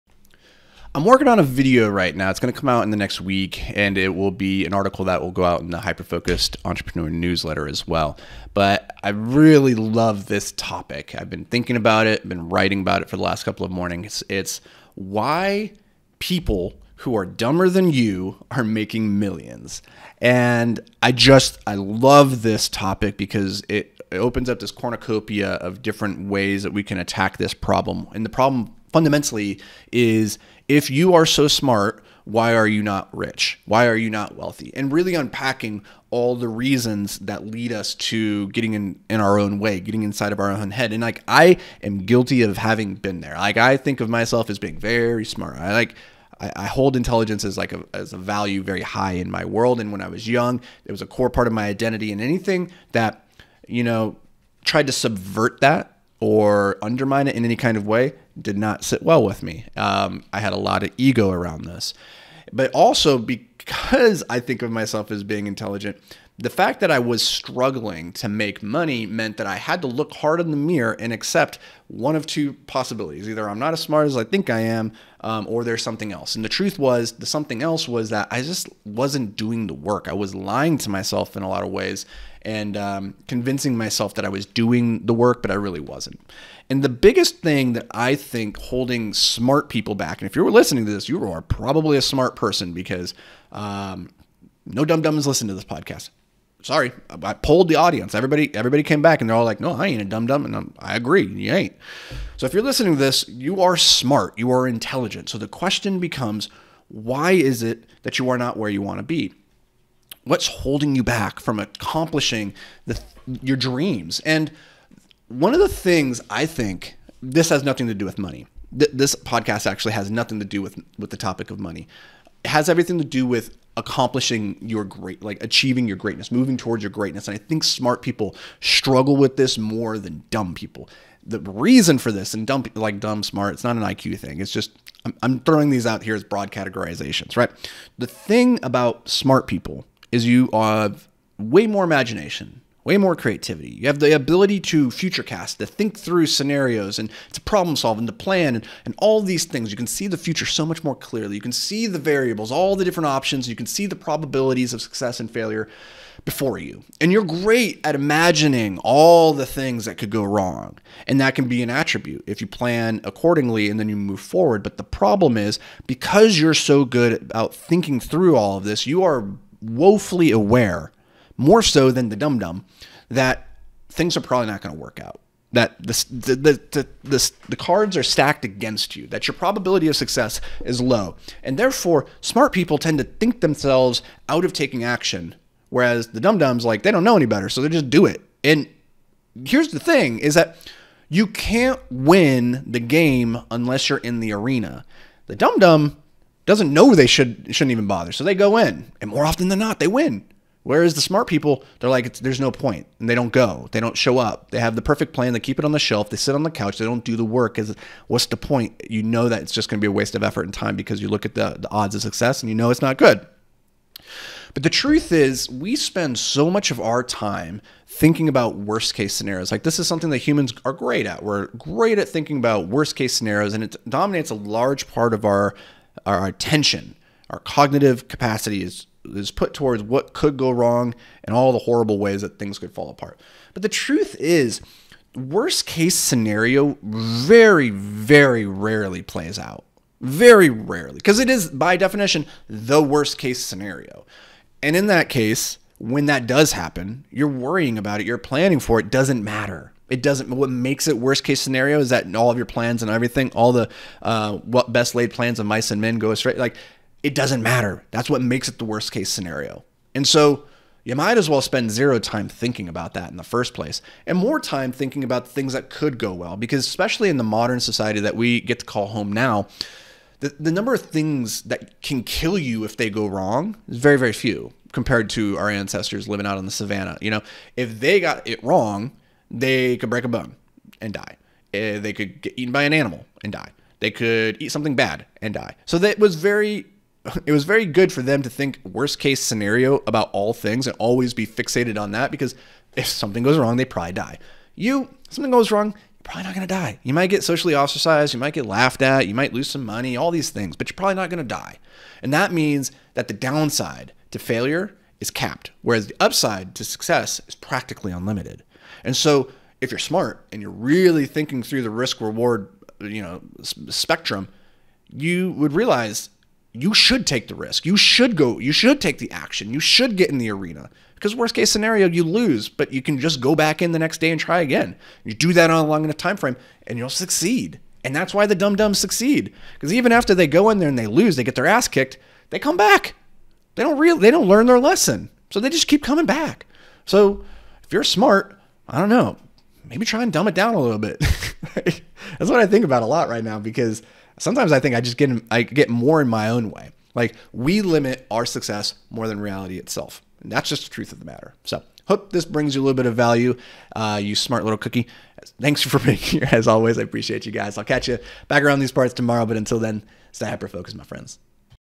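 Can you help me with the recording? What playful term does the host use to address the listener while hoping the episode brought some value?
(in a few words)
smart little cookie.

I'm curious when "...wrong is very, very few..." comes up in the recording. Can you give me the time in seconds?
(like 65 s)
273 s.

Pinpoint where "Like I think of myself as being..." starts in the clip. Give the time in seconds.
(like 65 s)
43 s.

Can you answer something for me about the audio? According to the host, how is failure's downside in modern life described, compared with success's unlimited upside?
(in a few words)
capped.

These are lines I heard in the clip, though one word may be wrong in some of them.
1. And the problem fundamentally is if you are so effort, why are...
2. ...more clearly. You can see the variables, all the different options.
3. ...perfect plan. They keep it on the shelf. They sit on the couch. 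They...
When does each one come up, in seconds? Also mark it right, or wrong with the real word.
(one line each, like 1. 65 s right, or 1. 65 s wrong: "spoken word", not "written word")
1. 28 s wrong: "smart", not "effort"
2. 150 s right
3. 204 s right.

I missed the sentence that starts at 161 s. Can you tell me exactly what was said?
And that can be an attribute if you plan accordingly and then you move forward.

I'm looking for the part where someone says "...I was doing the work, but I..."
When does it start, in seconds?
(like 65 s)
84 s.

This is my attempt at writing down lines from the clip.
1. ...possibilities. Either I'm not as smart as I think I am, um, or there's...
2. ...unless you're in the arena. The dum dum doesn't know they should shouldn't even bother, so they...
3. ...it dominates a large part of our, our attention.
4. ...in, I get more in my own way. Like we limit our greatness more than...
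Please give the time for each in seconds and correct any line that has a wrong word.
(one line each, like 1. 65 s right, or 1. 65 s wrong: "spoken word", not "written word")
1. 72 s right
2. 193 s right
3. 223 s right
4. 345 s wrong: "success", not "greatness".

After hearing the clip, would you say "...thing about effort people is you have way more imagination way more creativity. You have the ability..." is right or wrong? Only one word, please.
wrong.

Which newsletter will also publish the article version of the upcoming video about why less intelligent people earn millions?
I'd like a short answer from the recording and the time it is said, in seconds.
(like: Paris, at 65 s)
Hyperfocused Entrepreneur, at 5 s.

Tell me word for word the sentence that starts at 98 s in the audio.
Everybody, everybody came back and they're all like, "No, I ain't a dumb dumb," and I'm, I agree, you ain't.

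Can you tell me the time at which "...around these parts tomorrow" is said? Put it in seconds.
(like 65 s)
358 s.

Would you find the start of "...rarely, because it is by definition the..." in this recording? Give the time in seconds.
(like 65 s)
240 s.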